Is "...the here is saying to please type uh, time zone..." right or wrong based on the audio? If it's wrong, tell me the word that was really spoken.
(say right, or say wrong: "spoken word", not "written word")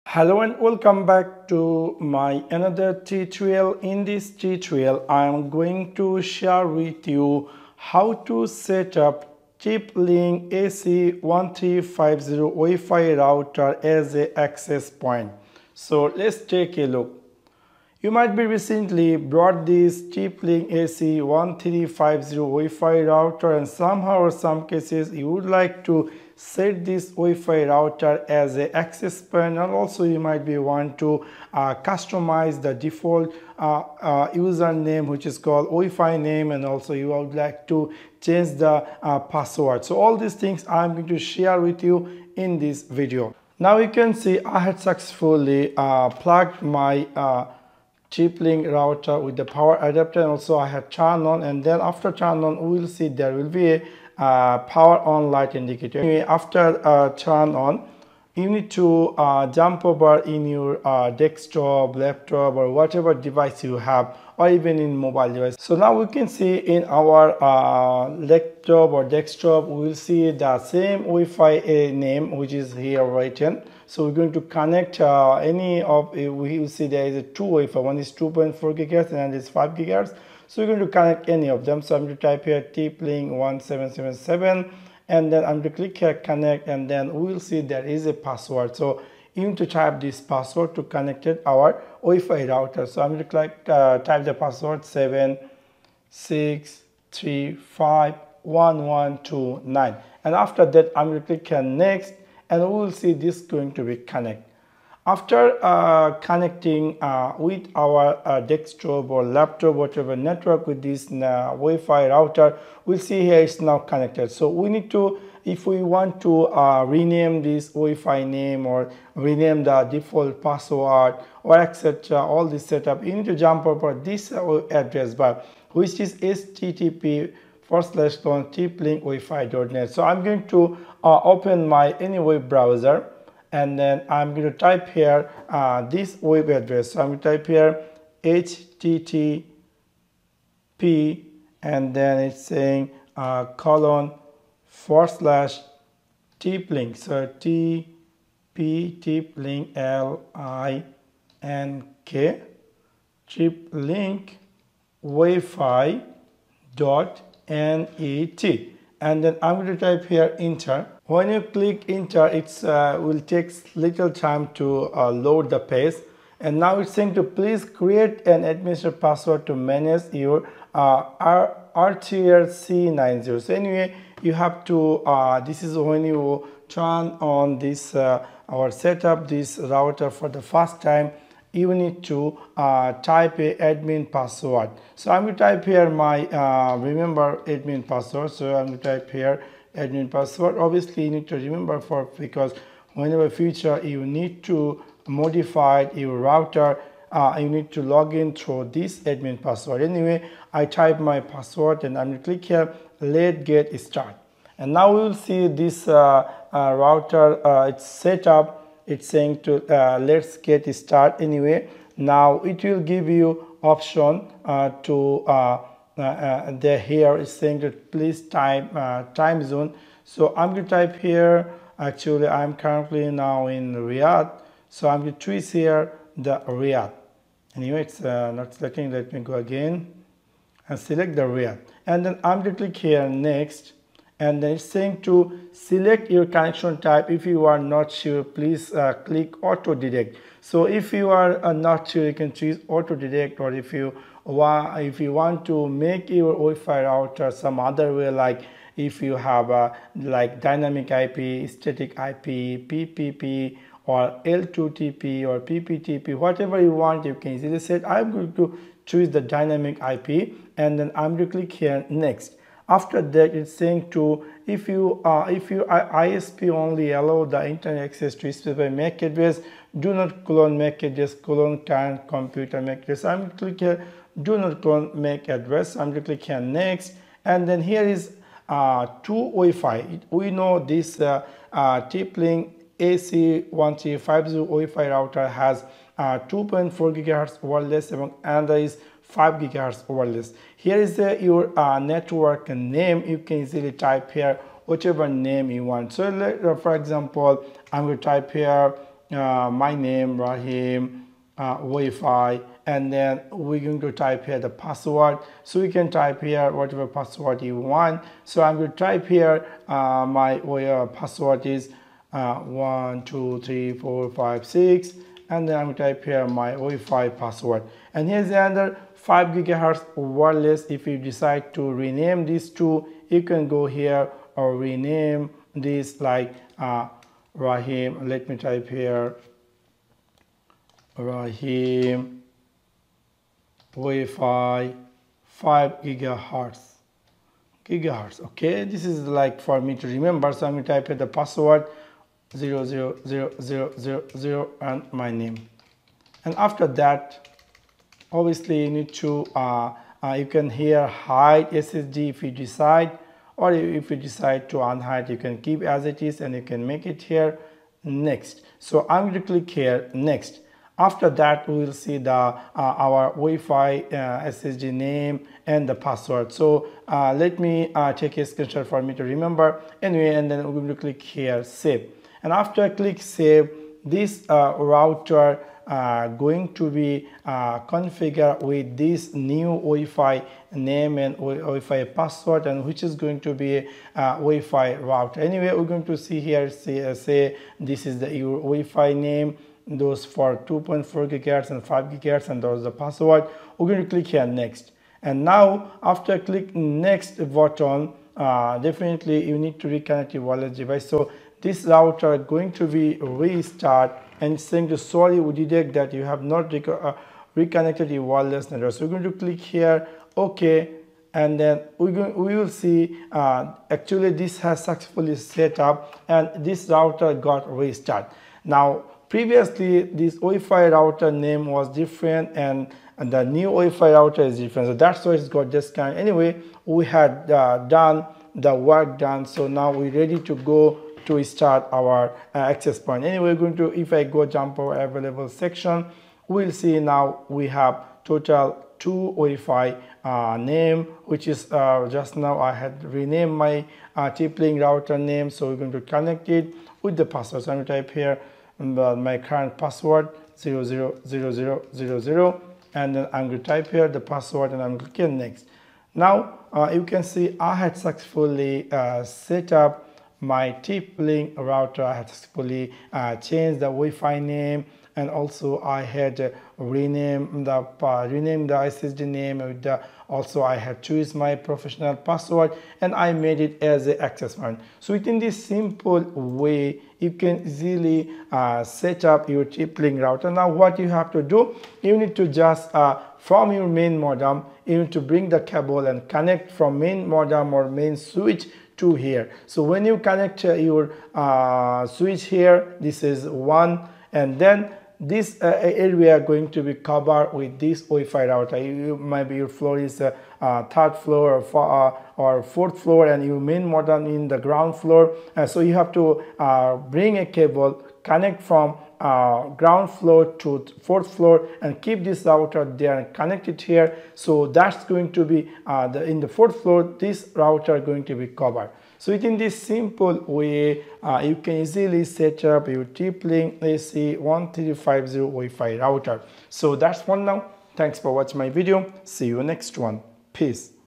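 right.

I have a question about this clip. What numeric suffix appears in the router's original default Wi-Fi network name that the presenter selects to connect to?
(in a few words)
1777.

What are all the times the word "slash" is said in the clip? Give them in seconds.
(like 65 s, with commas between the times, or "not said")
127 s, 145 s.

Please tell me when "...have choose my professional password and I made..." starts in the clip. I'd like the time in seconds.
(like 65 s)
470 s.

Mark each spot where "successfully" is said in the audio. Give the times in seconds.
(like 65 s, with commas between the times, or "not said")
44 s, 414 s, 457 s, 462 s.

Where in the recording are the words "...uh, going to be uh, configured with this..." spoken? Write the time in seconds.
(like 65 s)
375 s.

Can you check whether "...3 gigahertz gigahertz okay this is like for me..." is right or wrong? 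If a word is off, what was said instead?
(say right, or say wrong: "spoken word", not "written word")
wrong: "5", not "3".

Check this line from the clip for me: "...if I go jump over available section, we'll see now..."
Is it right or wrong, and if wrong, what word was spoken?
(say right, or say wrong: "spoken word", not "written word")
right.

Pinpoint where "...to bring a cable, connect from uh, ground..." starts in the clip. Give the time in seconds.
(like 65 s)
505 s.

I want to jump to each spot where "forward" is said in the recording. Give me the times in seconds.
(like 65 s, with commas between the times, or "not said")
127 s, 144 s.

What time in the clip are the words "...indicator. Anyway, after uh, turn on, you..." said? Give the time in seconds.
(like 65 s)
55 s.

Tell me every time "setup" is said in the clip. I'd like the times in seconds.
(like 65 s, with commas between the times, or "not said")
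122 s.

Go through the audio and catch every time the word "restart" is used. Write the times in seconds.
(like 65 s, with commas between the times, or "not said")
402 s, 417 s.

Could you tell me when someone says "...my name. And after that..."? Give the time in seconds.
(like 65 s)
344 s.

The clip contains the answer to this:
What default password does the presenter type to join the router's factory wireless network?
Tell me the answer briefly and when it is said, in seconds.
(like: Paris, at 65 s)
763511129, at 94 s.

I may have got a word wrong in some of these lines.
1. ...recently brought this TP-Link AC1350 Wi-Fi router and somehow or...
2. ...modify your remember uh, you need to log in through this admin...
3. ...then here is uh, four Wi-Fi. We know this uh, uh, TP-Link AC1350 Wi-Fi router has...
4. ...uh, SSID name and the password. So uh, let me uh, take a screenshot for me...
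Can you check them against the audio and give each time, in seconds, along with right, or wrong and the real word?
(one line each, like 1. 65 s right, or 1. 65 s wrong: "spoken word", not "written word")
1. 18 s right
2. 195 s wrong: "router", not "remember"
3. 277 s wrong: "two", not "four"
4. 363 s right.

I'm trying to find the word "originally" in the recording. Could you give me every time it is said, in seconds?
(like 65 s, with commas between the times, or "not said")
not said.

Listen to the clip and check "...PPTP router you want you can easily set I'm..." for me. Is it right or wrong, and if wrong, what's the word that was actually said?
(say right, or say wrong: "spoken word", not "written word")
wrong: "whatever", not "router".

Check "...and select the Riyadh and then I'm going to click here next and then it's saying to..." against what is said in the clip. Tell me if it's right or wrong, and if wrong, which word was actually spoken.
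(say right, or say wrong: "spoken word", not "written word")
right.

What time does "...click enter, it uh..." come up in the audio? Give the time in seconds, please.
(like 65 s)
161 s.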